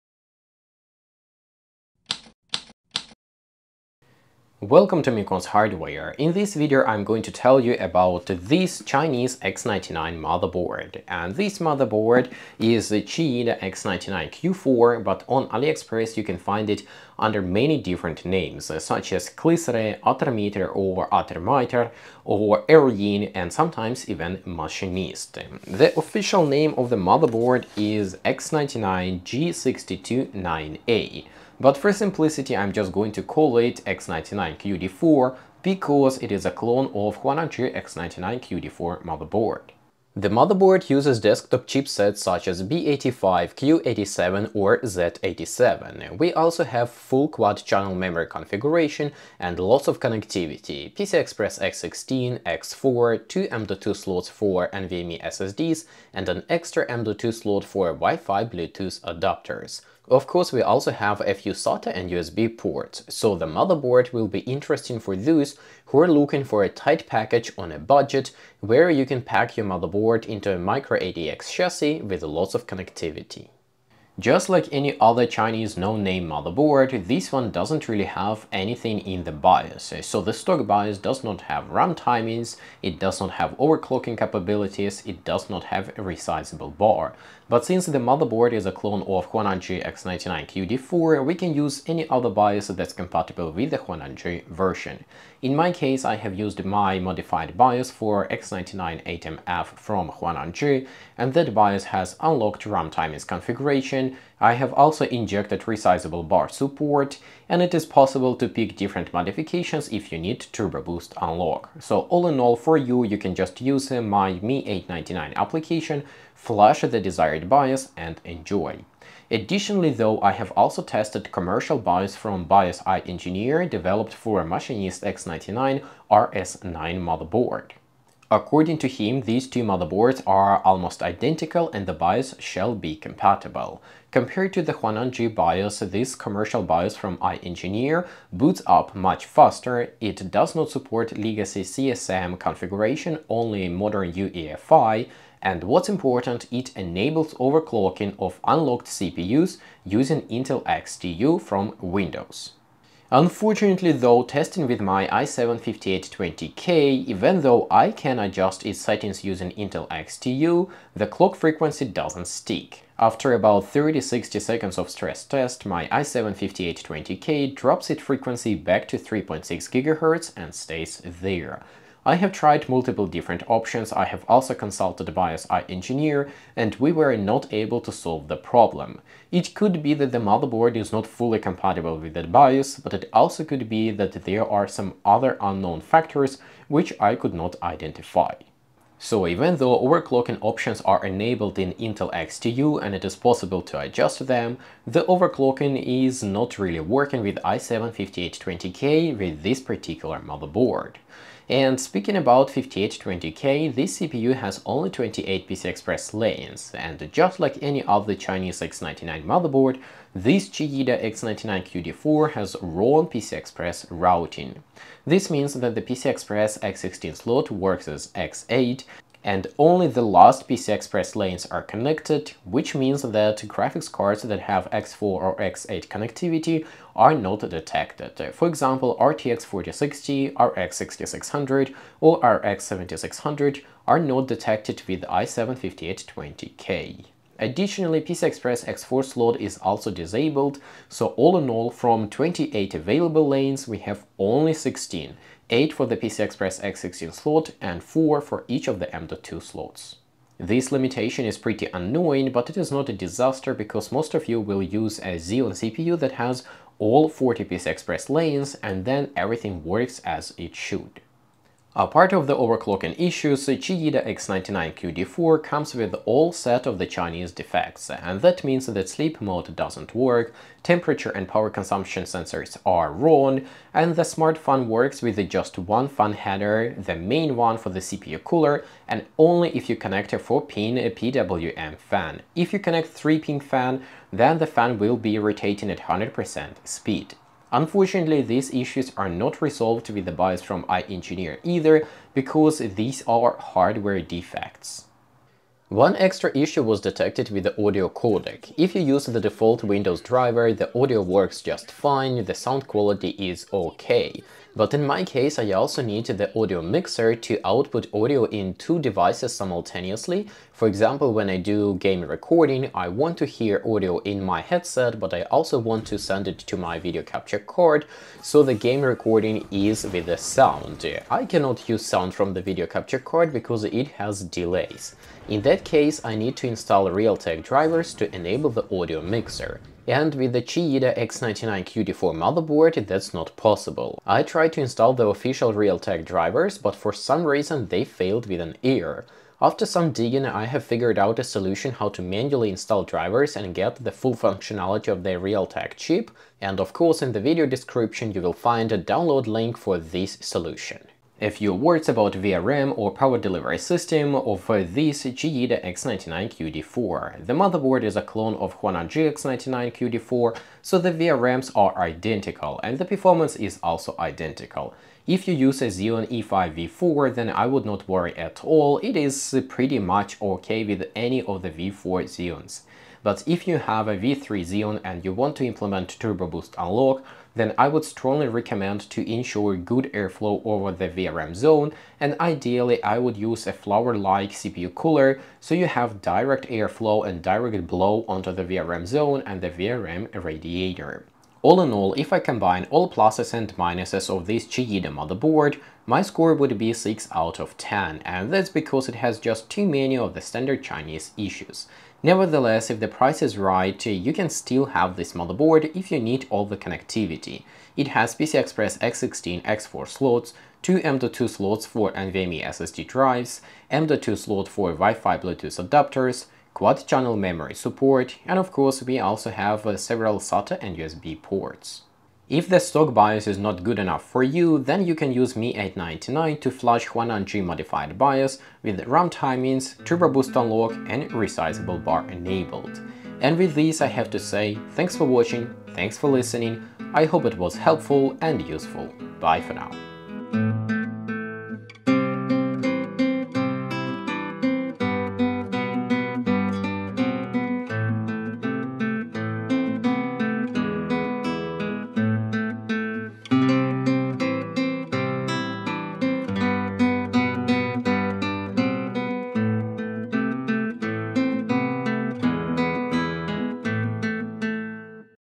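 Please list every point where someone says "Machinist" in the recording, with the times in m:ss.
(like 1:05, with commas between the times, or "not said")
0:24, 2:04.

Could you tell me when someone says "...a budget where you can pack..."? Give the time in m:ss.
1:07.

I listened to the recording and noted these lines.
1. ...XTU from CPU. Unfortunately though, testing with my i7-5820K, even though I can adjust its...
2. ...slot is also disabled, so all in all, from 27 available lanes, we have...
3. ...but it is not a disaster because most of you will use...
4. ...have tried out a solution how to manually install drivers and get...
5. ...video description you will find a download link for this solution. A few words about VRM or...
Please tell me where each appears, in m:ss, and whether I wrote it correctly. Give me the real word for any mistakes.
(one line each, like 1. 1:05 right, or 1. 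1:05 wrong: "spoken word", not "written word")
1. 2:30 wrong: "Windows", not "CPU"
2. 3:59 wrong: "28", not "27"
3. 4:12 right
4. 5:40 wrong: "figured", not "tried"
5. 5:47 right.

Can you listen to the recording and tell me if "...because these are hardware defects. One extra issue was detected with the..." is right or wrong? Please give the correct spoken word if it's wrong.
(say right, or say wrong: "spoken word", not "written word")
right.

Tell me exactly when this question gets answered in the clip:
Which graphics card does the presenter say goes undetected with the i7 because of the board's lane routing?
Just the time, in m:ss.
3:48.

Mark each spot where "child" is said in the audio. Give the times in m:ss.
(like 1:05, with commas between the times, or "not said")
not said.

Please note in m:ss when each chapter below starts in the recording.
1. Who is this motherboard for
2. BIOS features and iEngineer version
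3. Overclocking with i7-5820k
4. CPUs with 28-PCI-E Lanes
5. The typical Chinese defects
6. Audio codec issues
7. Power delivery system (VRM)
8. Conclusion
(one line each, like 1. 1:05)
1. 0:39
2. 1:13
3. 2:25
4. 3:21
5. 4:21
6. 4:55
7. 5:50
8. 6:31.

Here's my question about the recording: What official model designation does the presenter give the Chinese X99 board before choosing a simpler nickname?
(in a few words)
X99G629A.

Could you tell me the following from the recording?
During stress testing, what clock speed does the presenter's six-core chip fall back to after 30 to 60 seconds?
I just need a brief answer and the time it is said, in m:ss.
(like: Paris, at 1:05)
3.6 GHz, at 2:48.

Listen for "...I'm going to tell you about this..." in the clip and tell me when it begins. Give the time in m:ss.
0:06.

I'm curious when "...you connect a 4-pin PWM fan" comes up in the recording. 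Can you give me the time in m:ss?
4:39.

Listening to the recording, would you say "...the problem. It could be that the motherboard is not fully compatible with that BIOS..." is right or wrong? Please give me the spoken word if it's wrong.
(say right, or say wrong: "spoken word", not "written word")
right.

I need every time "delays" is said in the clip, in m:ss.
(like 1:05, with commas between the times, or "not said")
5:24.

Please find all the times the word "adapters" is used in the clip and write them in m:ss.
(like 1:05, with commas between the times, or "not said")
0:59, 6:55.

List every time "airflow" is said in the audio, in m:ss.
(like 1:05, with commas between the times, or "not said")
6:19, 6:26.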